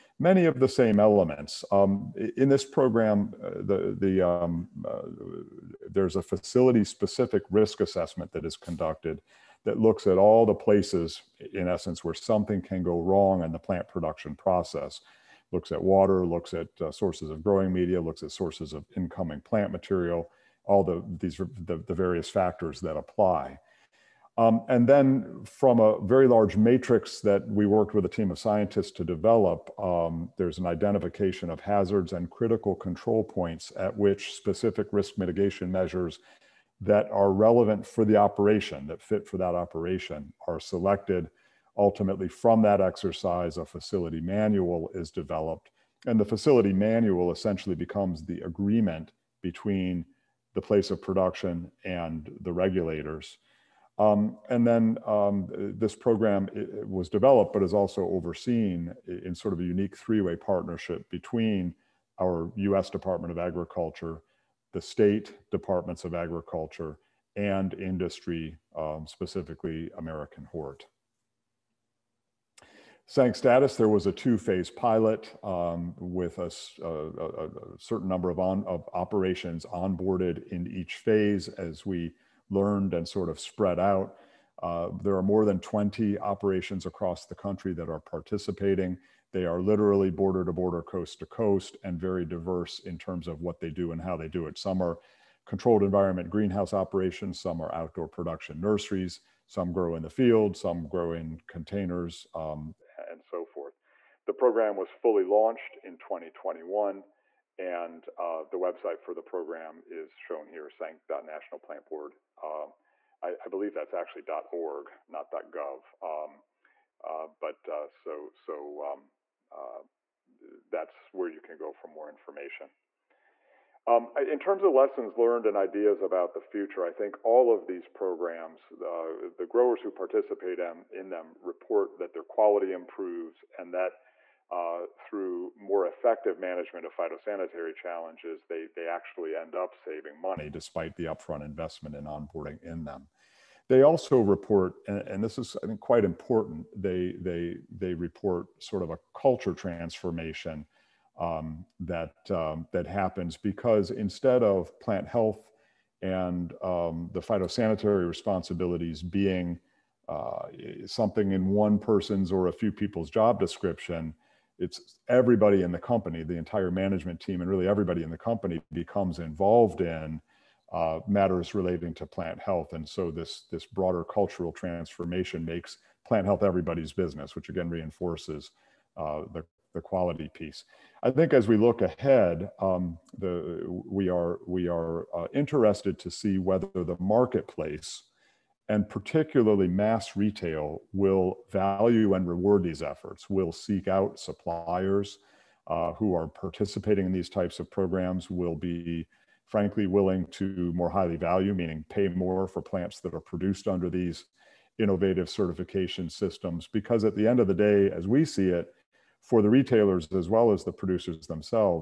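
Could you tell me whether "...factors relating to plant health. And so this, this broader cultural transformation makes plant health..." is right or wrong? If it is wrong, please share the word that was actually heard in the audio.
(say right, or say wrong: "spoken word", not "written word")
wrong: "matters", not "factors".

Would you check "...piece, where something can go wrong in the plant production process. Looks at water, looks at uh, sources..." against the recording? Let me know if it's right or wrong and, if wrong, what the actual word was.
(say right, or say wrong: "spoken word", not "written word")
wrong: "essence", not "piece".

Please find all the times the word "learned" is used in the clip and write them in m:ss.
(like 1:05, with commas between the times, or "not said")
1:22, 2:05.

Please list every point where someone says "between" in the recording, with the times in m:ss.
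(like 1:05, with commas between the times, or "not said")
0:49, 1:01.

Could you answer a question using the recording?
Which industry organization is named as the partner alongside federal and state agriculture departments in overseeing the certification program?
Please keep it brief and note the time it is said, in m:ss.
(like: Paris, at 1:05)
American Hort, at 1:09.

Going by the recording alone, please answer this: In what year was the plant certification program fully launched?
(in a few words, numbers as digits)
2021.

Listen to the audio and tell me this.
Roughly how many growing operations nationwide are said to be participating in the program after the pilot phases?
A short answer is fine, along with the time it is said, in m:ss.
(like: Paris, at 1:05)
more than 20, at 1:25.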